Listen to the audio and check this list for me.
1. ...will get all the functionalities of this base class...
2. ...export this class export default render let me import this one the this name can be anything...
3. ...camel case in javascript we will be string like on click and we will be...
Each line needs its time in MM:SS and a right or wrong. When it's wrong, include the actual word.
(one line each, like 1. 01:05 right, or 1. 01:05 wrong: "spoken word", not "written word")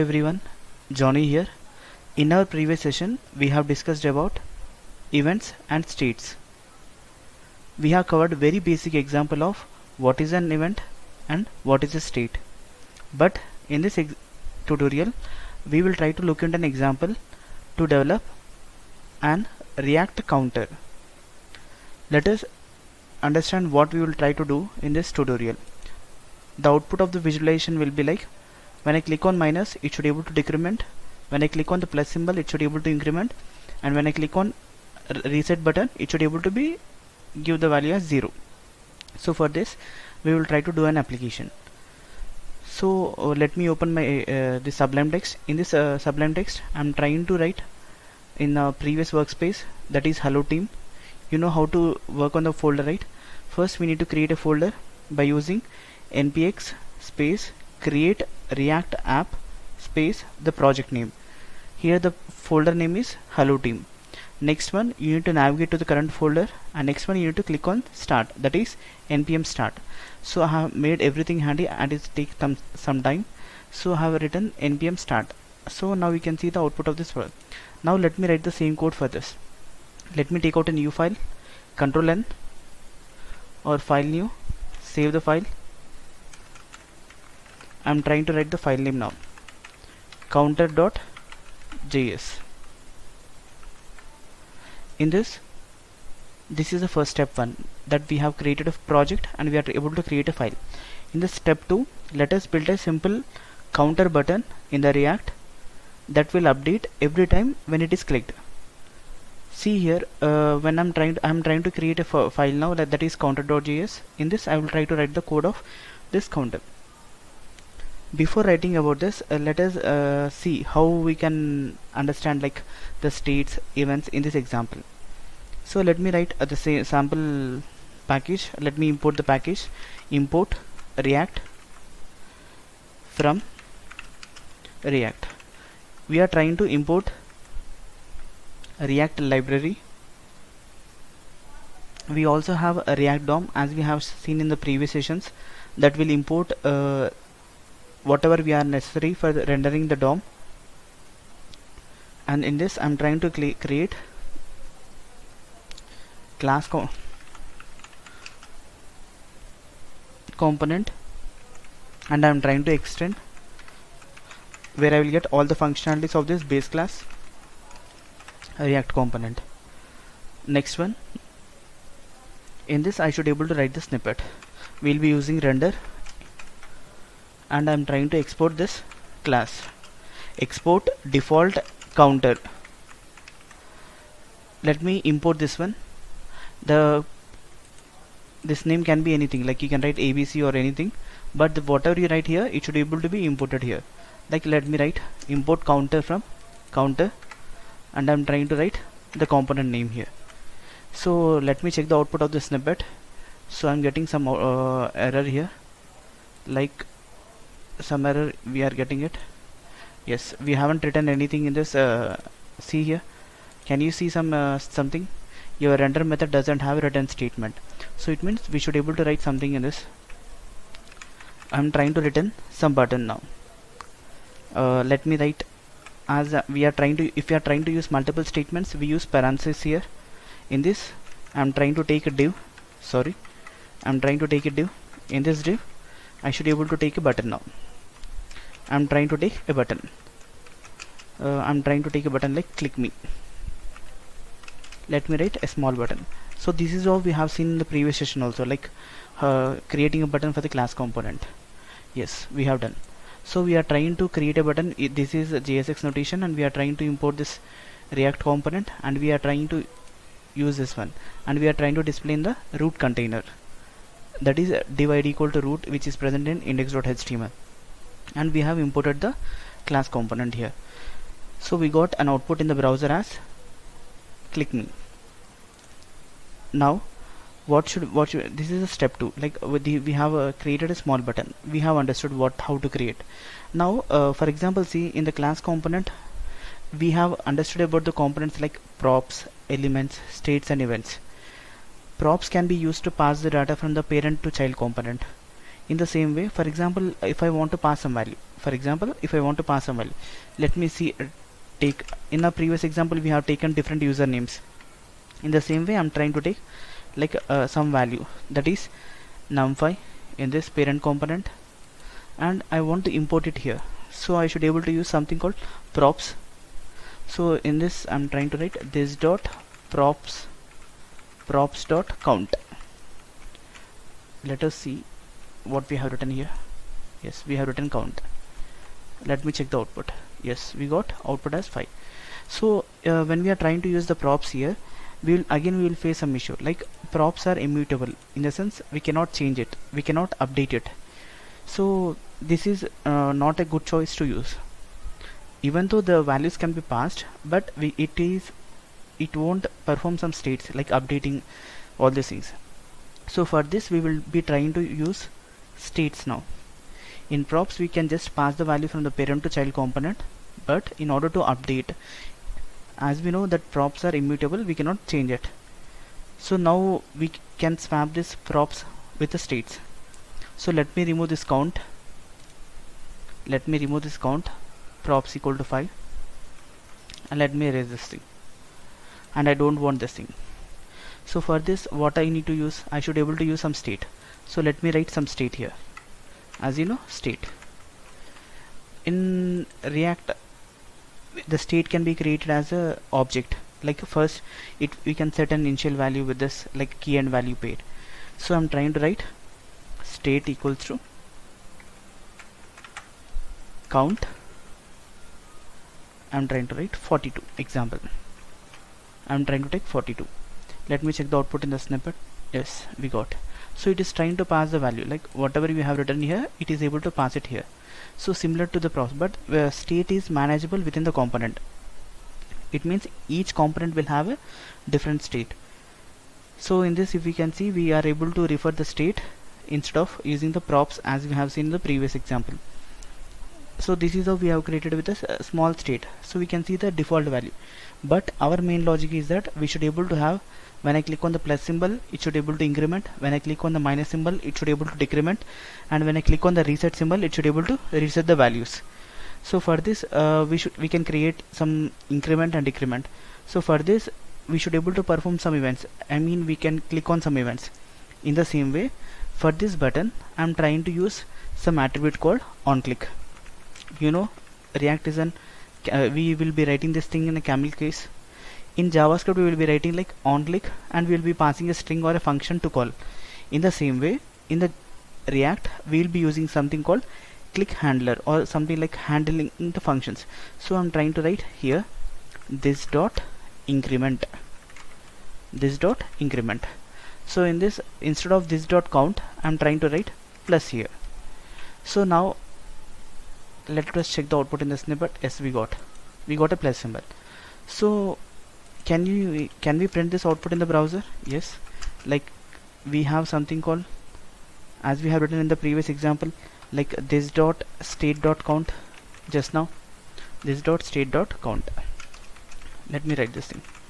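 1. 02:44 right
2. 02:58 wrong: "counter", not "render"
3. 07:47 wrong: "writing", not "string".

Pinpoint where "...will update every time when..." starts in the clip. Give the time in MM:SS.
01:46.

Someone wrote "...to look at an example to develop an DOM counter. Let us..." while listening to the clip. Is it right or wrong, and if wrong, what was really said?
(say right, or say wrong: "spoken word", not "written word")
wrong: "React", not "DOM".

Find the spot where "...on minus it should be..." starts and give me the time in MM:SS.
00:29.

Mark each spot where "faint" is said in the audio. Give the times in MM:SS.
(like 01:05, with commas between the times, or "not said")
not said.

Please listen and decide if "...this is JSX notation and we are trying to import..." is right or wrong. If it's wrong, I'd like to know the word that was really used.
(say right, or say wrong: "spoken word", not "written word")
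right.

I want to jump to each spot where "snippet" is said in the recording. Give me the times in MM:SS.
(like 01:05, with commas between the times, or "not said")
02:53, 03:22, 06:51, 08:14.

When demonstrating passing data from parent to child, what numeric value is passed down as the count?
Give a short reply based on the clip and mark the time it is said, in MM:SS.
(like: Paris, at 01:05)
5, at 05:09.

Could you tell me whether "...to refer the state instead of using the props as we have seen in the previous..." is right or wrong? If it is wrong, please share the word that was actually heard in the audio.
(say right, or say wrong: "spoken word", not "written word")
right.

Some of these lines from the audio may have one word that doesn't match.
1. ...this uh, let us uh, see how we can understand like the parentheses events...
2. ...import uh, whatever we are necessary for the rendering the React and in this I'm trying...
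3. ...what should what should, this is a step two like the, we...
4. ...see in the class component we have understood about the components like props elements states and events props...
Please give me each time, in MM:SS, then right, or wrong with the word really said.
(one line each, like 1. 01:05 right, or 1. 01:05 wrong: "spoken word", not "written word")
1. 01:58 wrong: "states", not "parentheses"
2. 02:26 wrong: "DOM", not "React"
3. 04:37 right
4. 04:44 right.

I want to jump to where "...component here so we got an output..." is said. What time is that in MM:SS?
04:29.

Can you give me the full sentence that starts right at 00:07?
We have covered very basic example of what is an event and what is a state.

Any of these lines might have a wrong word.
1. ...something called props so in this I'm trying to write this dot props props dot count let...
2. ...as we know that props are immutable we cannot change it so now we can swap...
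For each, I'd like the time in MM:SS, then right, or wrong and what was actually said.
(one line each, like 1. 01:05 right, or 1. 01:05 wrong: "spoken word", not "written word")
1. 05:14 right
2. 06:02 right.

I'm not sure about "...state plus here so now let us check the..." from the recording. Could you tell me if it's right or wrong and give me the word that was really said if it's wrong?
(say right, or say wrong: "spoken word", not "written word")
wrong: "write", not "state".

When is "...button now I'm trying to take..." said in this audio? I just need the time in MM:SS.
03:57.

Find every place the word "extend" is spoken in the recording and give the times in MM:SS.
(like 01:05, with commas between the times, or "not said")
02:42.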